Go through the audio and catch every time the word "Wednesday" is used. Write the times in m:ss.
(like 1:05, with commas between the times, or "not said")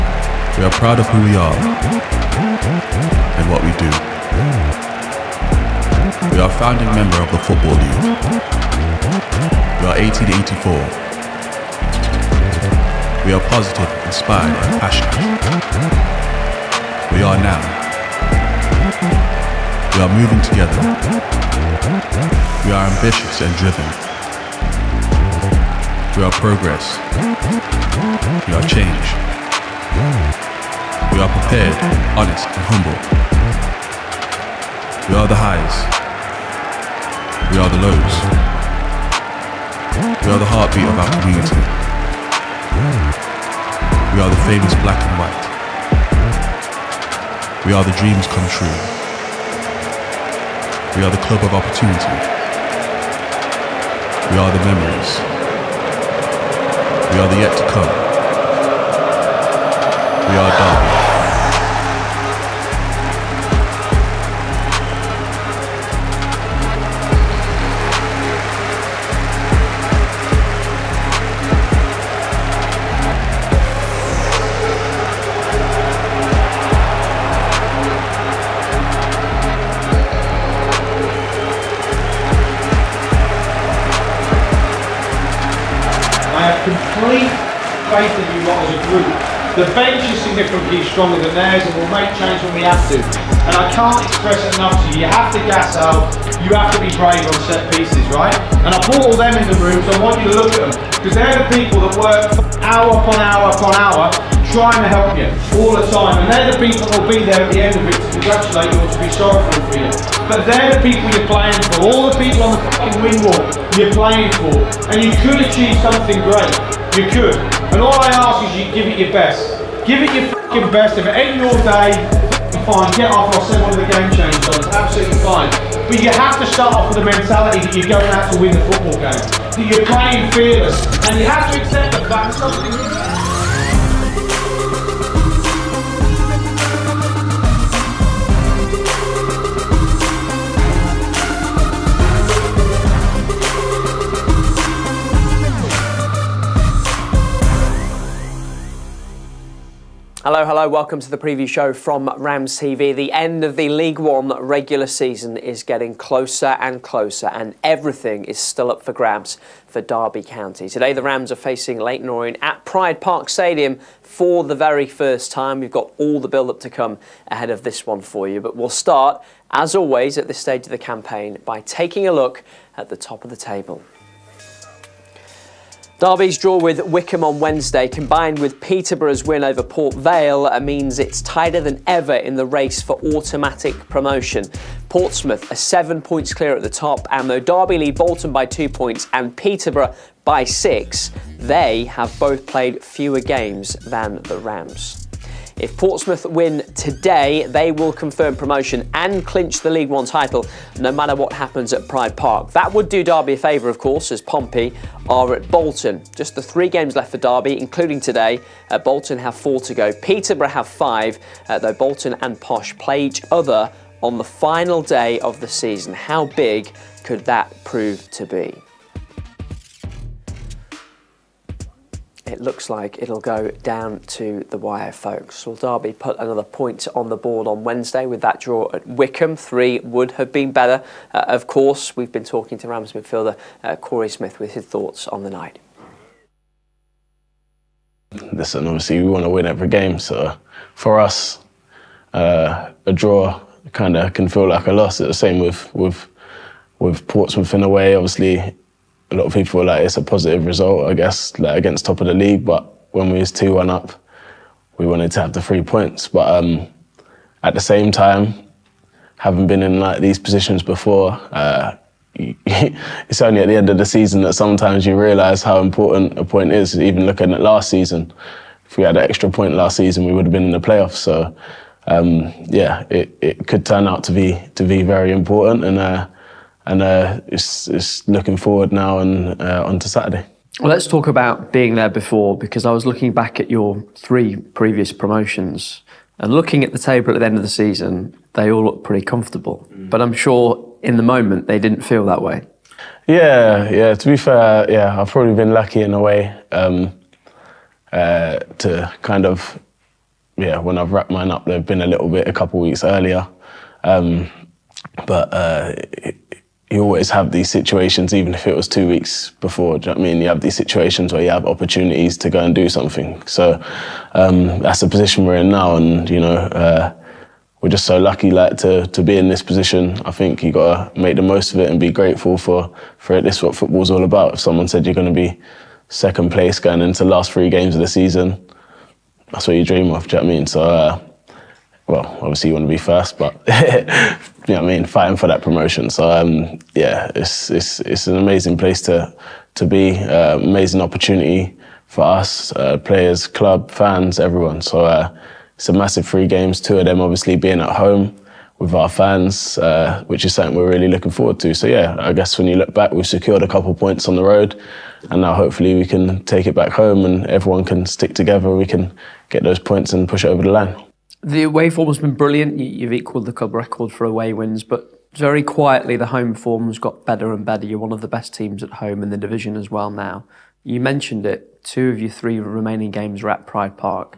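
2:57, 3:47.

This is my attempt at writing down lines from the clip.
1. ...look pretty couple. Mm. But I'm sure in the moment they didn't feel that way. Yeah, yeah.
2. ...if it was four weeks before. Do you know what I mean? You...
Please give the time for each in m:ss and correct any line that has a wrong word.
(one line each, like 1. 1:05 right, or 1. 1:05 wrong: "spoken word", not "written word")
1. 4:48 wrong: "comfortable", not "couple"
2. 5:08 wrong: "two", not "four".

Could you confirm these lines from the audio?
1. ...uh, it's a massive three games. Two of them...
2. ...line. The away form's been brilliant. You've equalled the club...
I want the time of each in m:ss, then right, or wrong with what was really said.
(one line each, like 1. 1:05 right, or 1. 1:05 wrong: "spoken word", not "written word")
1. 5:44 right
2. 6:00 right.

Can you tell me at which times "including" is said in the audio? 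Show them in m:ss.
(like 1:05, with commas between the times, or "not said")
3:27.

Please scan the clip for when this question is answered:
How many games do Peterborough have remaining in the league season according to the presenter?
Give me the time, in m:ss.
3:30.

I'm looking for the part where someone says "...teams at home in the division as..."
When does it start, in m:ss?
6:08.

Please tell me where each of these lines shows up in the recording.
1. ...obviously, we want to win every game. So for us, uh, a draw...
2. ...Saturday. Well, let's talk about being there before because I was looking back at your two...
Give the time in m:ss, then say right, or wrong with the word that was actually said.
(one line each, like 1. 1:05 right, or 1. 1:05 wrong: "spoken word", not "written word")
1. 3:58 right
2. 4:39 wrong: "three", not "two".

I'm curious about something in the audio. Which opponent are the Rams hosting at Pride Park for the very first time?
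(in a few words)
Leyton Orient.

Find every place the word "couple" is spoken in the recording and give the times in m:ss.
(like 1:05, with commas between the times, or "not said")
5:02, 5:53.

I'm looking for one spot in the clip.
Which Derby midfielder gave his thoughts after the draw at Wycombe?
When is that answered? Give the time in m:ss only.
3:53.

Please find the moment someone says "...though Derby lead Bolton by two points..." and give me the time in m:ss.
3:07.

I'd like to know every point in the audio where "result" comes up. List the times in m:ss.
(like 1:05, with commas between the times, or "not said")
4:10.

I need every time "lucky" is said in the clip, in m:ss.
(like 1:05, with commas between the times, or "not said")
4:55, 5:17.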